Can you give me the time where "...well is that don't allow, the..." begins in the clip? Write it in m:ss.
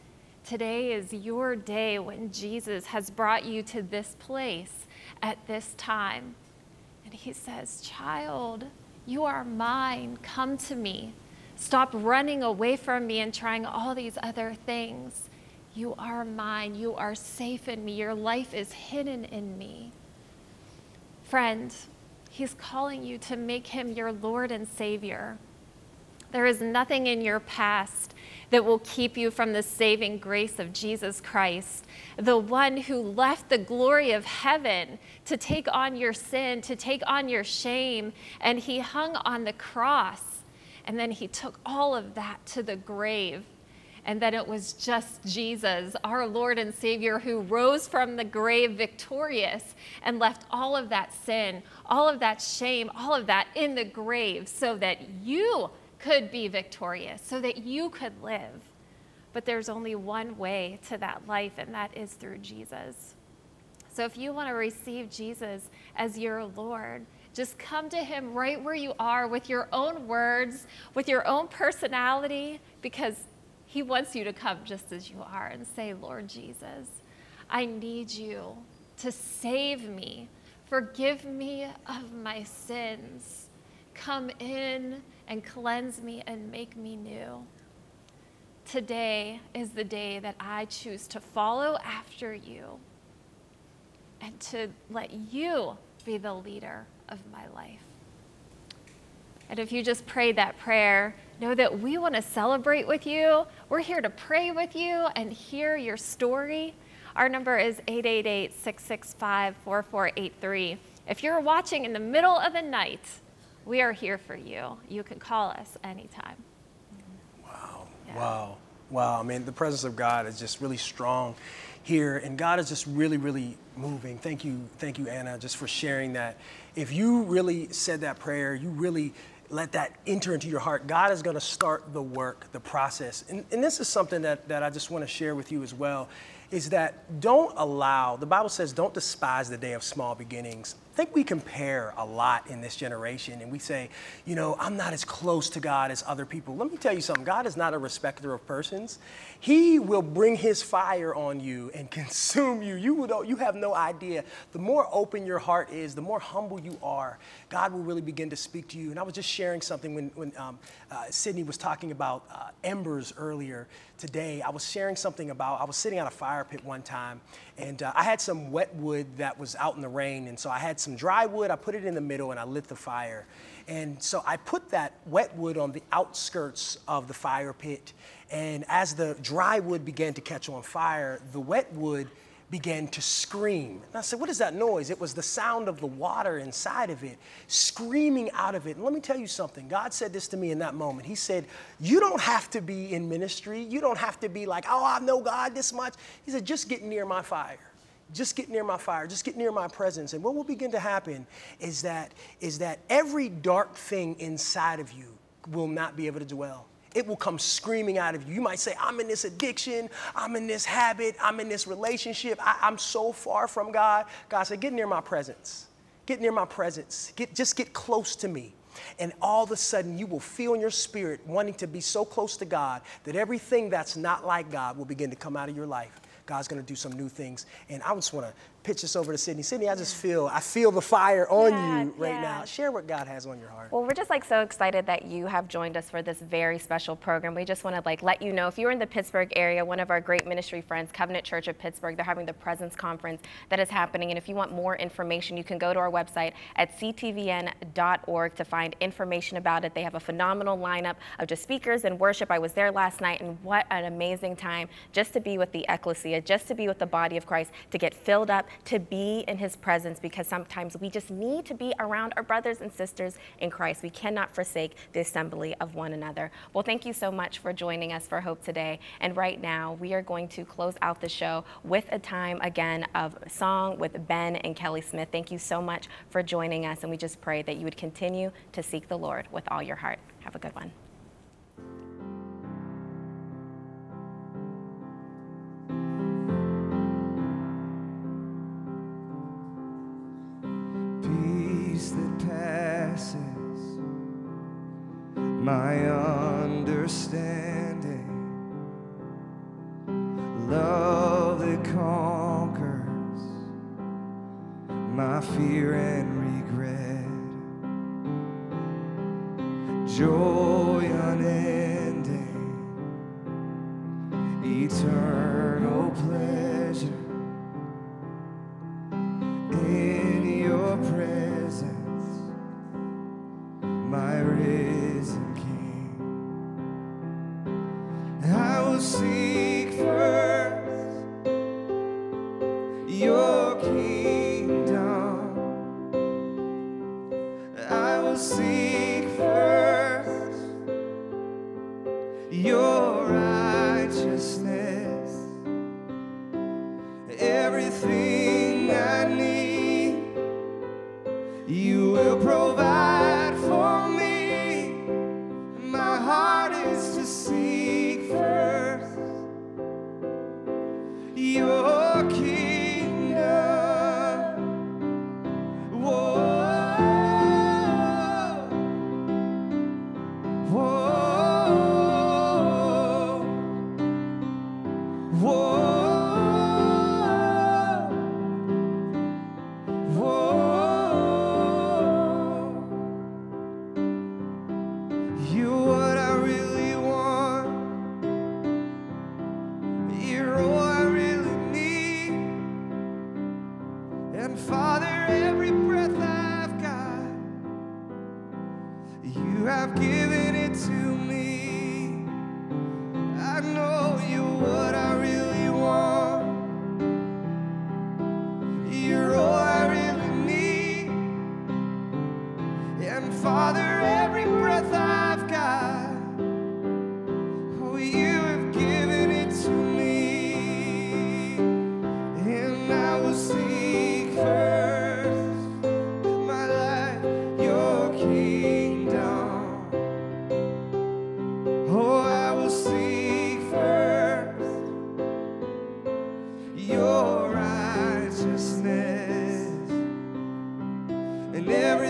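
2:15.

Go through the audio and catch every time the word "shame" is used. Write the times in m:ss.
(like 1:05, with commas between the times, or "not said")
0:37, 0:52.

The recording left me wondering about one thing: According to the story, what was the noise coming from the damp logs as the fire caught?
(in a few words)
the water inside.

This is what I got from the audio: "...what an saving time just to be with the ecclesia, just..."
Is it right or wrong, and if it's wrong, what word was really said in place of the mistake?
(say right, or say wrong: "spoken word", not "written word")
wrong: "amazing", not "saving".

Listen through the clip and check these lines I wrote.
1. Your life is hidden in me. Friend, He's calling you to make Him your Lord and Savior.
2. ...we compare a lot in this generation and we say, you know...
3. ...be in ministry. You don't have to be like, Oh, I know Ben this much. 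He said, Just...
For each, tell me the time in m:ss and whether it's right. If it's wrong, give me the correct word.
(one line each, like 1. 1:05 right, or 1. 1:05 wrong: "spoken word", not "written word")
1. 0:17 right
2. 2:21 right
3. 3:12 wrong: "God", not "Ben".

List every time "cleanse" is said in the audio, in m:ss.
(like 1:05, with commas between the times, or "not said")
1:25.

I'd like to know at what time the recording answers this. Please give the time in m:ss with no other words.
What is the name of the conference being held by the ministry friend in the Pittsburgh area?
4:02.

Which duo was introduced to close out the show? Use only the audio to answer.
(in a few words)
Ben and Kelly Smith.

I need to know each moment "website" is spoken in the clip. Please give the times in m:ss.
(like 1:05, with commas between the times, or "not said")
4:05.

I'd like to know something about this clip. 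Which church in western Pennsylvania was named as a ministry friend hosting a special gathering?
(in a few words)
Covenant Church of Pittsburgh.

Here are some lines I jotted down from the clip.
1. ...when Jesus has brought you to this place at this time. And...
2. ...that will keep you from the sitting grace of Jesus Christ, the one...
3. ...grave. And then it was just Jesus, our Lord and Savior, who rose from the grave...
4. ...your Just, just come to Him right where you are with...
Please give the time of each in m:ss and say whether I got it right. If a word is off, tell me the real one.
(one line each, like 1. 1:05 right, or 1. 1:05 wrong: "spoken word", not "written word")
1. 0:01 right
2. 0:28 wrong: "saving", not "sitting"
3. 0:42 right
4. 1:06 wrong: "Lord", not "Just".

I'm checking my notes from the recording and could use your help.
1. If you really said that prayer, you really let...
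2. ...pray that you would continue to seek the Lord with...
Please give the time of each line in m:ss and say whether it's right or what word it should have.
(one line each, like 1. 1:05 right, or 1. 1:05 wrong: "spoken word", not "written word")
1. 2:06 right
2. 4:37 right.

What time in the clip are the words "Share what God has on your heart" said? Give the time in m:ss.
3:52.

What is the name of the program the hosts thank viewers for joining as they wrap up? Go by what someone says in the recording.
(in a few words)
Hope.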